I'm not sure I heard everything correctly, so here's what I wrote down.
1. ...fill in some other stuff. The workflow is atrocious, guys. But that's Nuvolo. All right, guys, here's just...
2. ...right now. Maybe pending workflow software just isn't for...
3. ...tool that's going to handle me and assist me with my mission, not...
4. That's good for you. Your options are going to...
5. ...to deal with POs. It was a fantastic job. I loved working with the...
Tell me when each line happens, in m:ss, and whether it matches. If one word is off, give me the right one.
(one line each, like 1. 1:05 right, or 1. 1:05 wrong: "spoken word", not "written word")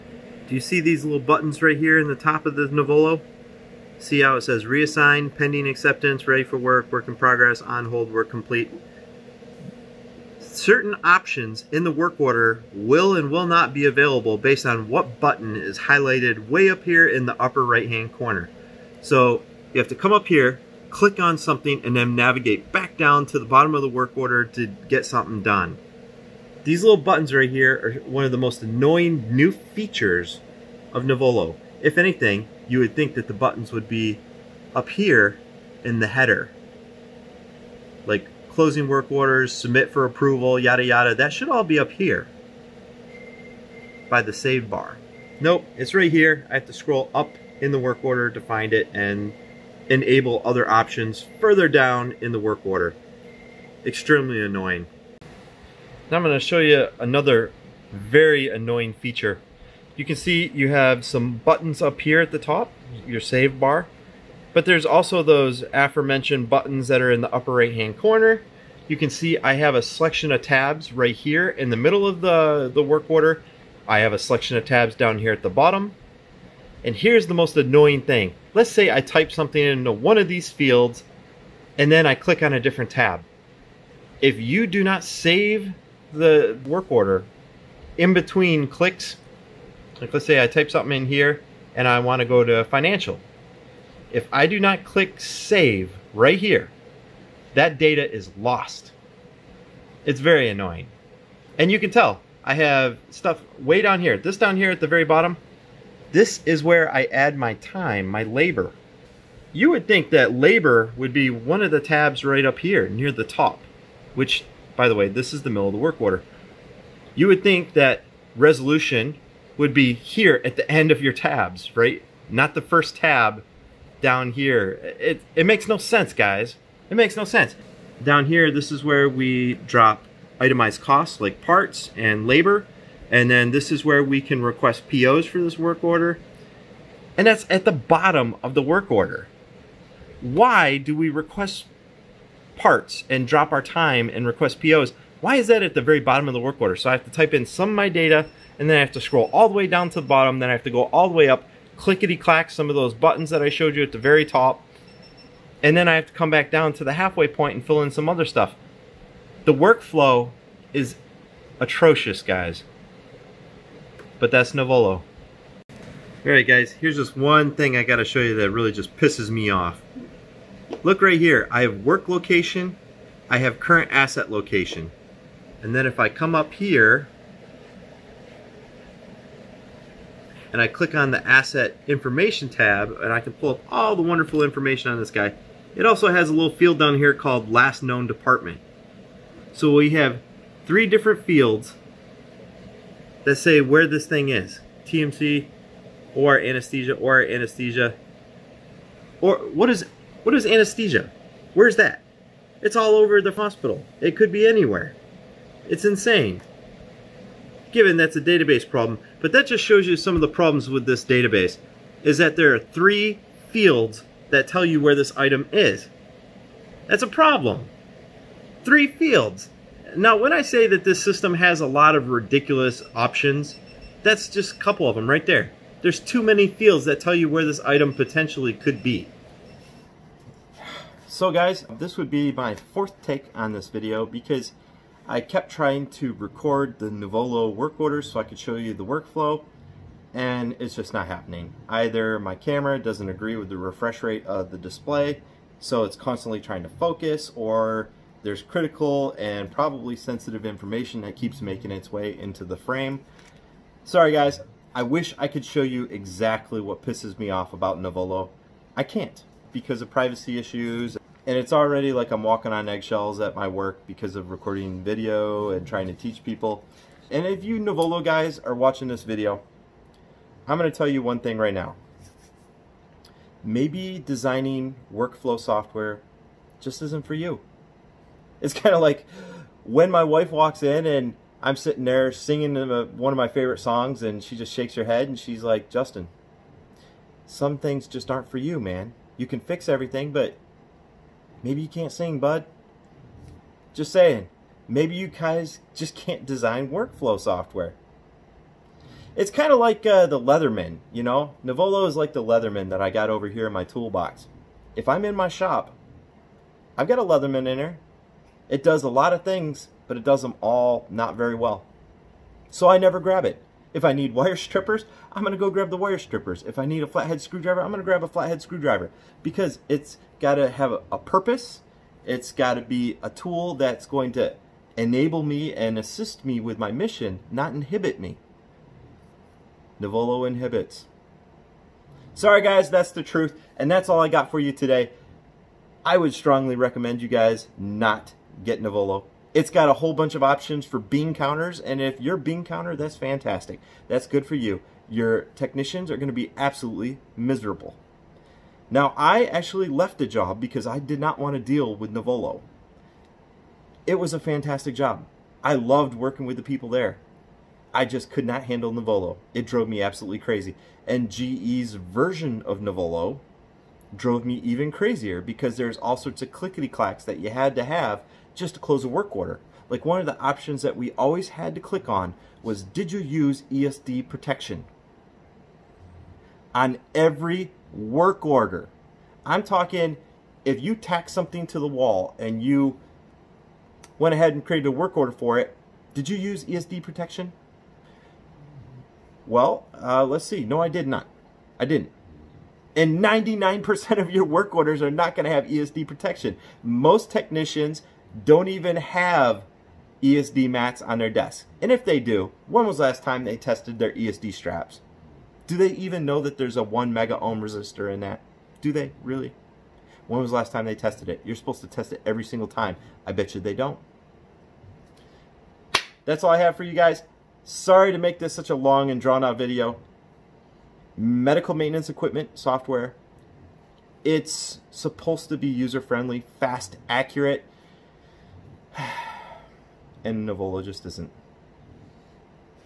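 1. 2:37 right
2. 4:31 wrong: "designing", not "pending"
3. 5:23 wrong: "enable", not "handle"
4. 5:43 wrong: "technicians", not "options"
5. 5:51 wrong: "Nuvolo", not "POs".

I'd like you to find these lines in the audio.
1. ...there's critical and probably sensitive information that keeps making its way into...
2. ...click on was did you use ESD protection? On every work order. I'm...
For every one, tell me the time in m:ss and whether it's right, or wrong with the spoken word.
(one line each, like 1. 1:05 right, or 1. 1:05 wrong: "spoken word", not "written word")
1. 4:08 right
2. 6:11 right.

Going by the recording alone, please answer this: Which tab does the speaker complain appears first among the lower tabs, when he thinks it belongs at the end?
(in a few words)
Resolution.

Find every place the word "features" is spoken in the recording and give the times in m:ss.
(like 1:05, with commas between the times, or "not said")
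0:29, 0:58.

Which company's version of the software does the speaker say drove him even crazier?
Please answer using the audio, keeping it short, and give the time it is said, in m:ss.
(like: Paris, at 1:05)
GE, at 6:01.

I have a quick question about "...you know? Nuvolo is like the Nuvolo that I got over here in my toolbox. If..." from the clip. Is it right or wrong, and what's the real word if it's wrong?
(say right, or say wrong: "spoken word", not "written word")
wrong: "Leatherman", not "Nuvolo".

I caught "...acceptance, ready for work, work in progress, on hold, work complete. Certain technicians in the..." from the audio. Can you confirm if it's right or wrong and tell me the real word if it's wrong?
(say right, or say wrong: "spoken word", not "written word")
wrong: "options", not "technicians".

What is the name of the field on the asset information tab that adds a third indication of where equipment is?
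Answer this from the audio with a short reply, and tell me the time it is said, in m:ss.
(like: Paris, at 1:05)
Last known department, at 3:07.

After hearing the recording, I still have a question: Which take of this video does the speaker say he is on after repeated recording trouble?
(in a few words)
Fourth.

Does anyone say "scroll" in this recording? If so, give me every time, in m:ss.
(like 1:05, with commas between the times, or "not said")
0:46, 2:28.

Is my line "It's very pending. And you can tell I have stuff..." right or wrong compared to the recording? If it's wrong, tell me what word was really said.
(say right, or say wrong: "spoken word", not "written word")
wrong: "annoying", not "pending".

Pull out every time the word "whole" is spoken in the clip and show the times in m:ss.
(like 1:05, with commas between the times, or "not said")
5:39.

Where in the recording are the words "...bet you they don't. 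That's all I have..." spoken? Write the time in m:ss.
6:53.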